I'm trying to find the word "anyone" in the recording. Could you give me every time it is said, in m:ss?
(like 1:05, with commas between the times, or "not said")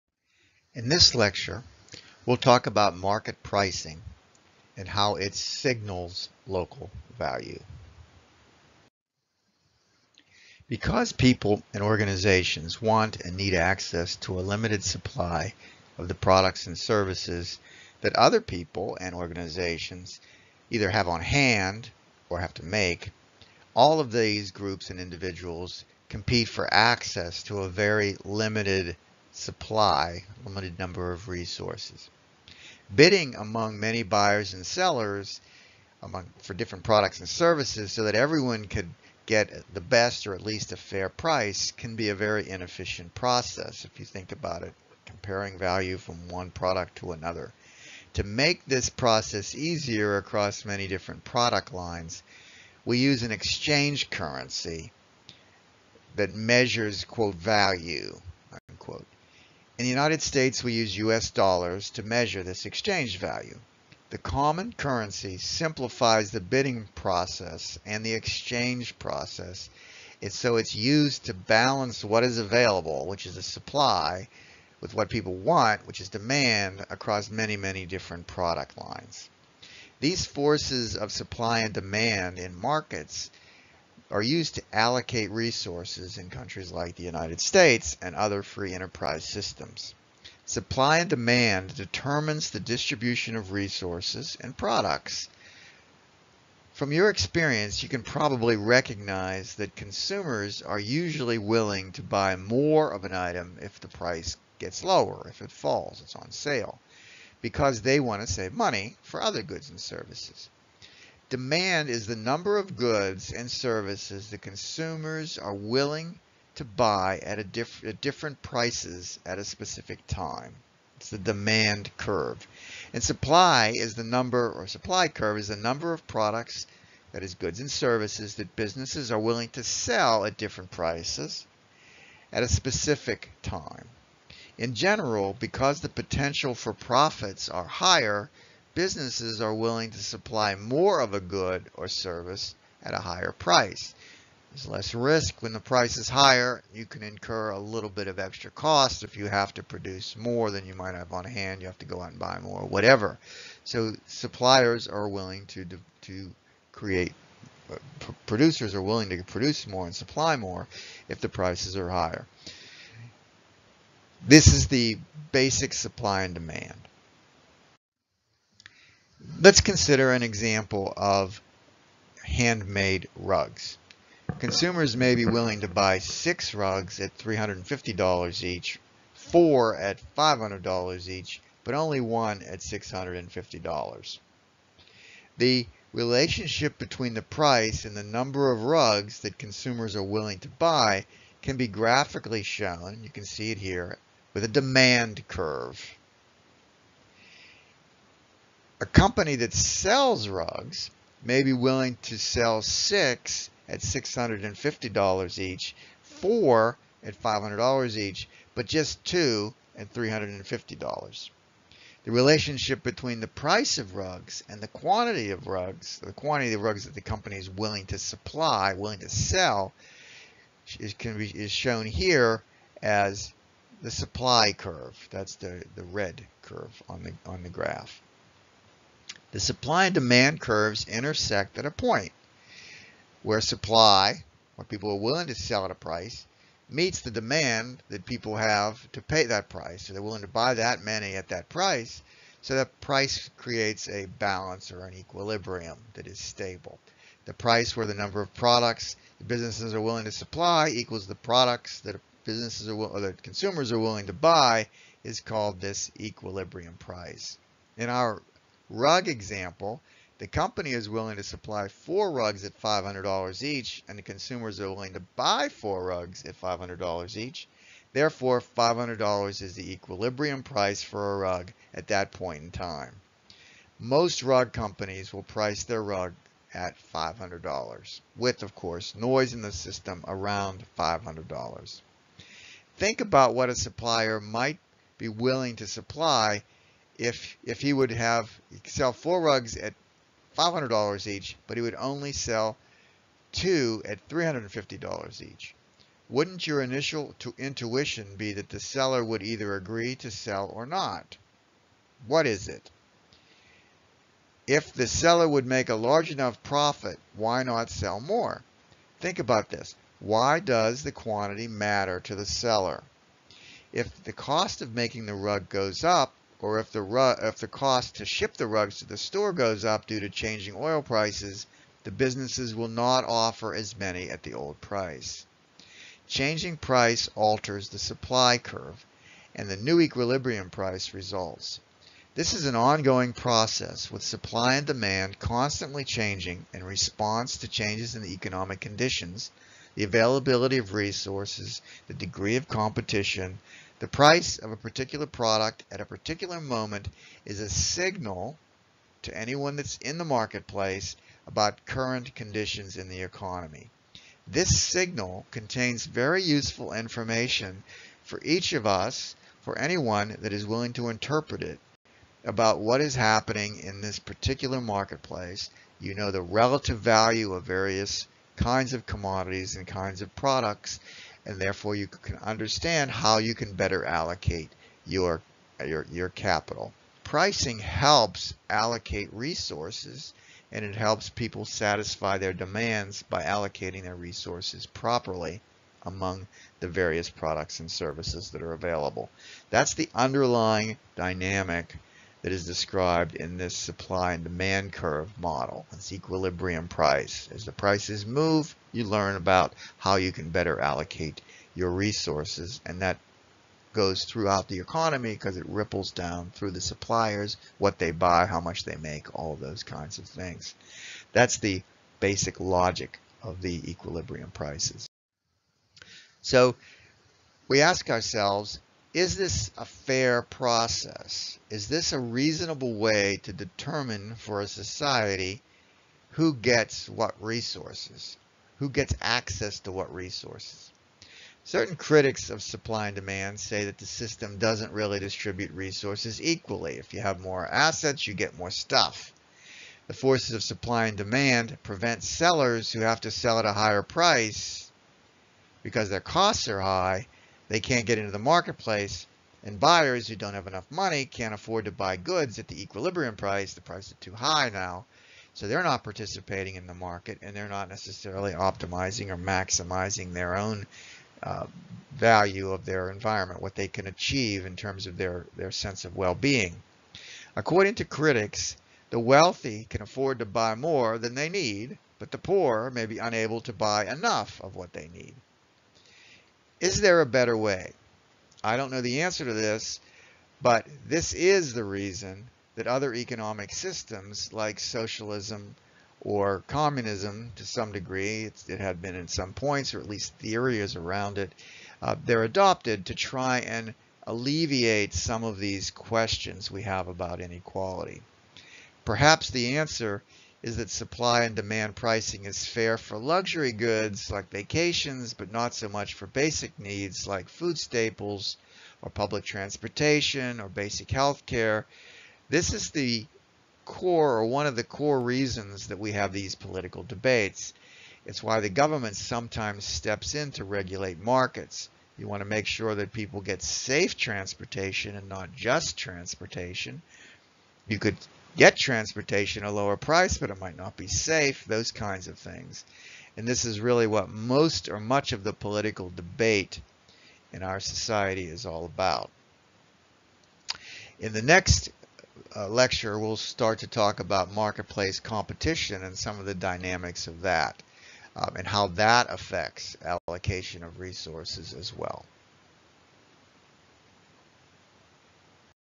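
5:49, 5:59.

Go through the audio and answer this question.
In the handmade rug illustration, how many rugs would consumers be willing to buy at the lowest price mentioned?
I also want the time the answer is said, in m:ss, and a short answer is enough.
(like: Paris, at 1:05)
6, at 2:55.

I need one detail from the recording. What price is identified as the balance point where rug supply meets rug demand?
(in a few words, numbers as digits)
$500.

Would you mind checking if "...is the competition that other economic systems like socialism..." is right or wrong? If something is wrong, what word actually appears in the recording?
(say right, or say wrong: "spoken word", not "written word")
wrong: "reason", not "competition".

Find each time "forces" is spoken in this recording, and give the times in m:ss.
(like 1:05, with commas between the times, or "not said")
1:20, 7:19.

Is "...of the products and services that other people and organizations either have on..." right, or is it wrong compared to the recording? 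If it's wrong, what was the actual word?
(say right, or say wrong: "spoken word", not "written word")
right.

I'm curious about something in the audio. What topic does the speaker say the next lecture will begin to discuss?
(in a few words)
Marketplace competition.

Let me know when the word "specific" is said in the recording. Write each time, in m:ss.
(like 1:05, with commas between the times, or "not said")
1:59, 2:12.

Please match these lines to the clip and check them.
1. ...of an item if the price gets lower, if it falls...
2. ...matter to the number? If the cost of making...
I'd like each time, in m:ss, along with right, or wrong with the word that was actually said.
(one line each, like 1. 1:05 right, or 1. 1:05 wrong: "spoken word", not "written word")
1. 1:42 right
2. 5:11 wrong: "seller", not "number".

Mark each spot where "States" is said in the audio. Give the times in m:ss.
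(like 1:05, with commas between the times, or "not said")
1:00, 1:27.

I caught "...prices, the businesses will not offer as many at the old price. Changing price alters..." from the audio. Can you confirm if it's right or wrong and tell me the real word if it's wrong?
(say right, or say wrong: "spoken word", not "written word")
right.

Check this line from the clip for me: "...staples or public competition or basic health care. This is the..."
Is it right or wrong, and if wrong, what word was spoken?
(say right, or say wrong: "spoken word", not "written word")
wrong: "transportation", not "competition".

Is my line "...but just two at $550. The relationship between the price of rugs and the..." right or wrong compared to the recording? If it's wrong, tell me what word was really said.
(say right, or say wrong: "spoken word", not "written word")
wrong: "350", not "550".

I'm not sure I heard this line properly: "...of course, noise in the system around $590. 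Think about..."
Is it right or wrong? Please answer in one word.
wrong.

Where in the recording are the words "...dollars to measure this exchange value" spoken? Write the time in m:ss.
1:01.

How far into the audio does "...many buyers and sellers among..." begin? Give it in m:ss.
0:33.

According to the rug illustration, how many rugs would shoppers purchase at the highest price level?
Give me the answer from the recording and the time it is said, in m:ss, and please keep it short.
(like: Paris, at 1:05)
1, at 3:01.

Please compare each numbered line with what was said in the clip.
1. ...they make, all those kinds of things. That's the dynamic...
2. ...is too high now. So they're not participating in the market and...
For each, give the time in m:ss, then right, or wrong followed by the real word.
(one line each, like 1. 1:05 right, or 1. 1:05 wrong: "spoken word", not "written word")
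1. 6:48 wrong: "basic", not "dynamic"
2. 7:33 right.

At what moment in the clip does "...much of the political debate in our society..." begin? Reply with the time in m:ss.
8:54.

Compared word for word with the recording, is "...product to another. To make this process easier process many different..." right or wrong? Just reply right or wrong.
wrong.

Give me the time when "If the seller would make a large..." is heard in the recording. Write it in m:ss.
5:04.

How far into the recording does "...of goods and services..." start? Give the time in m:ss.
1:52.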